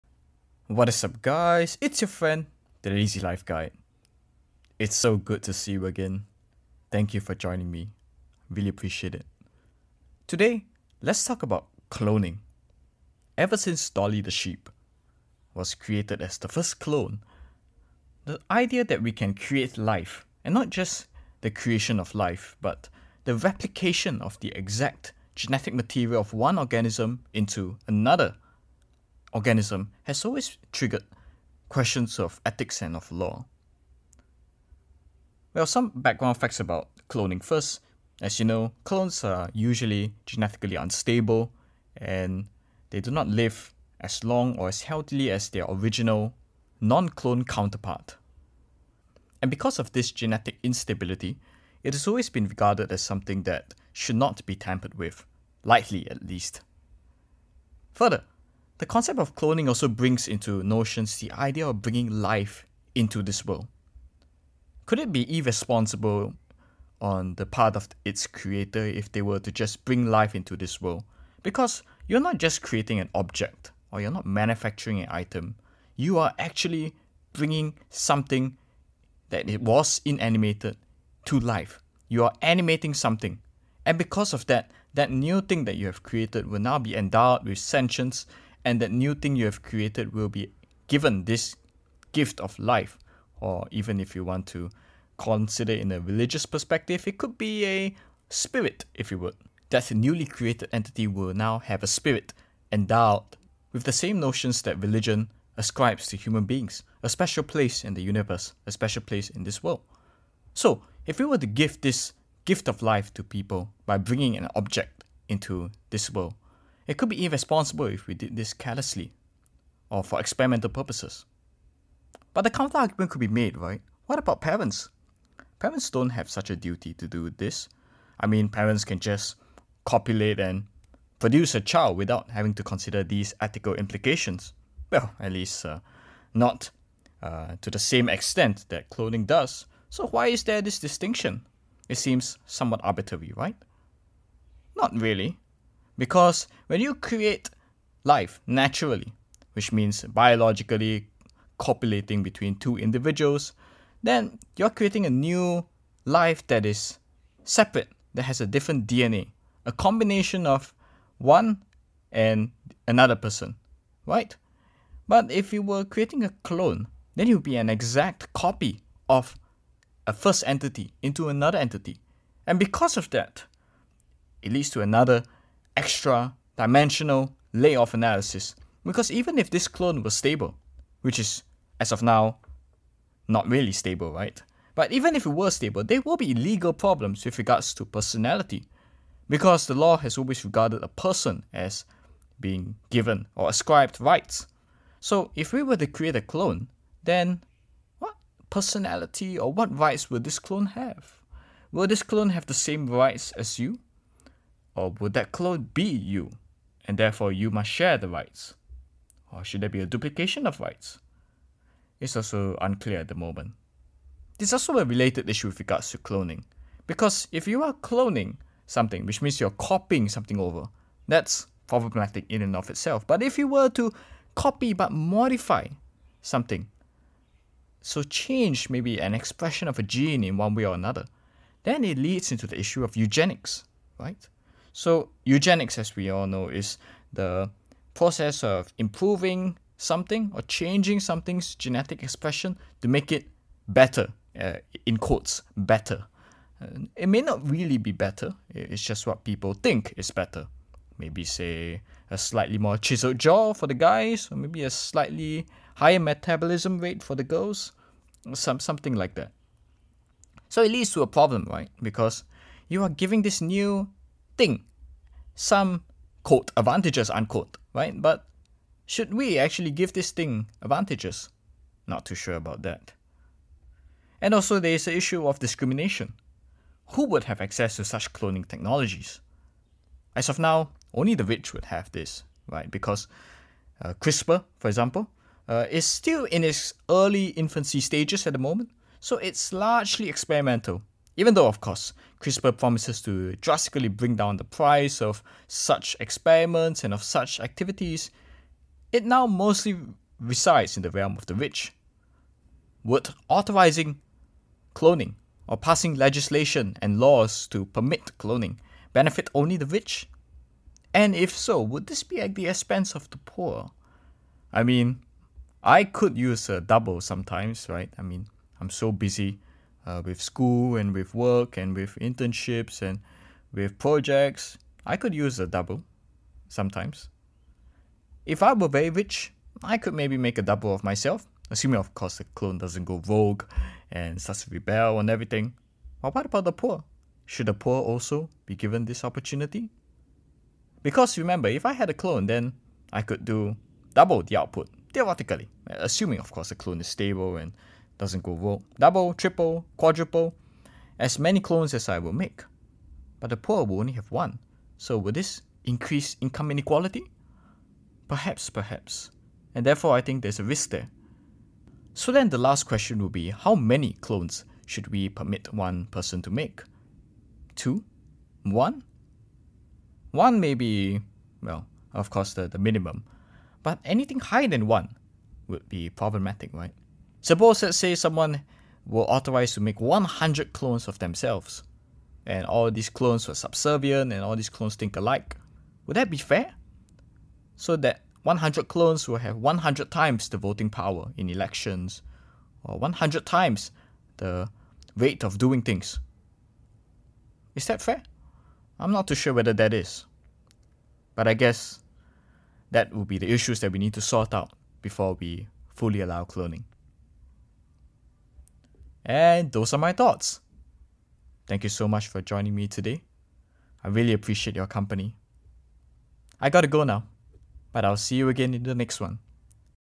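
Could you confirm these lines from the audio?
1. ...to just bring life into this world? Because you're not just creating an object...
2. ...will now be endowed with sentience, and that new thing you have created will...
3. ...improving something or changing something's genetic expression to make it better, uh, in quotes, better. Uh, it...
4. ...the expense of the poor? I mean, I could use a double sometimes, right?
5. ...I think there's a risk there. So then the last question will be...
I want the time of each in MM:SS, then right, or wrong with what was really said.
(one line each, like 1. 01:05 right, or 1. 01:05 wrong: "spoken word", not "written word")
1. 01:09 right
2. 01:26 right
3. 03:58 right
4. 05:12 right
5. 05:59 right.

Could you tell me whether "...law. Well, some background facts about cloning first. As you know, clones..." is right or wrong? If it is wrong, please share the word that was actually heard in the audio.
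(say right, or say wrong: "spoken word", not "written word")
right.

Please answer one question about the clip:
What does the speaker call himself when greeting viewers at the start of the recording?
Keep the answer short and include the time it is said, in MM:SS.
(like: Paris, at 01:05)
the Lazy Life Guide, at 00:02.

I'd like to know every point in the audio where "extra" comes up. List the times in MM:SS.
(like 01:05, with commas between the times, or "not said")
02:55.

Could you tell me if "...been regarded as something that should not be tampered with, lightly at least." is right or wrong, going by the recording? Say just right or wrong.
right.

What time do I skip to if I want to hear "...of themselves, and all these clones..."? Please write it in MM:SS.
06:20.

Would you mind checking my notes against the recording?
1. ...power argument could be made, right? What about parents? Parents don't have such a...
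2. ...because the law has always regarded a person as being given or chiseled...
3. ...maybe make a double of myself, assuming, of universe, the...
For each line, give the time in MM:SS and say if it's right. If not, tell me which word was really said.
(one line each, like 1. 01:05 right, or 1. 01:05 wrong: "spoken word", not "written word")
1. 02:02 wrong: "counter", not "power"
2. 03:09 wrong: "ascribed", not "chiseled"
3. 05:29 wrong: "course", not "universe".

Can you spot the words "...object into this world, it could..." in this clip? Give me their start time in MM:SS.
01:54.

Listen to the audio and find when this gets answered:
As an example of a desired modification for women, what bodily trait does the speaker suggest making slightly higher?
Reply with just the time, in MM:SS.
04:15.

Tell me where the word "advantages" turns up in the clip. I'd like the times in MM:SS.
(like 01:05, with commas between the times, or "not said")
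04:26, 04:30.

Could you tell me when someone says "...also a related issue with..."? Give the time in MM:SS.
03:34.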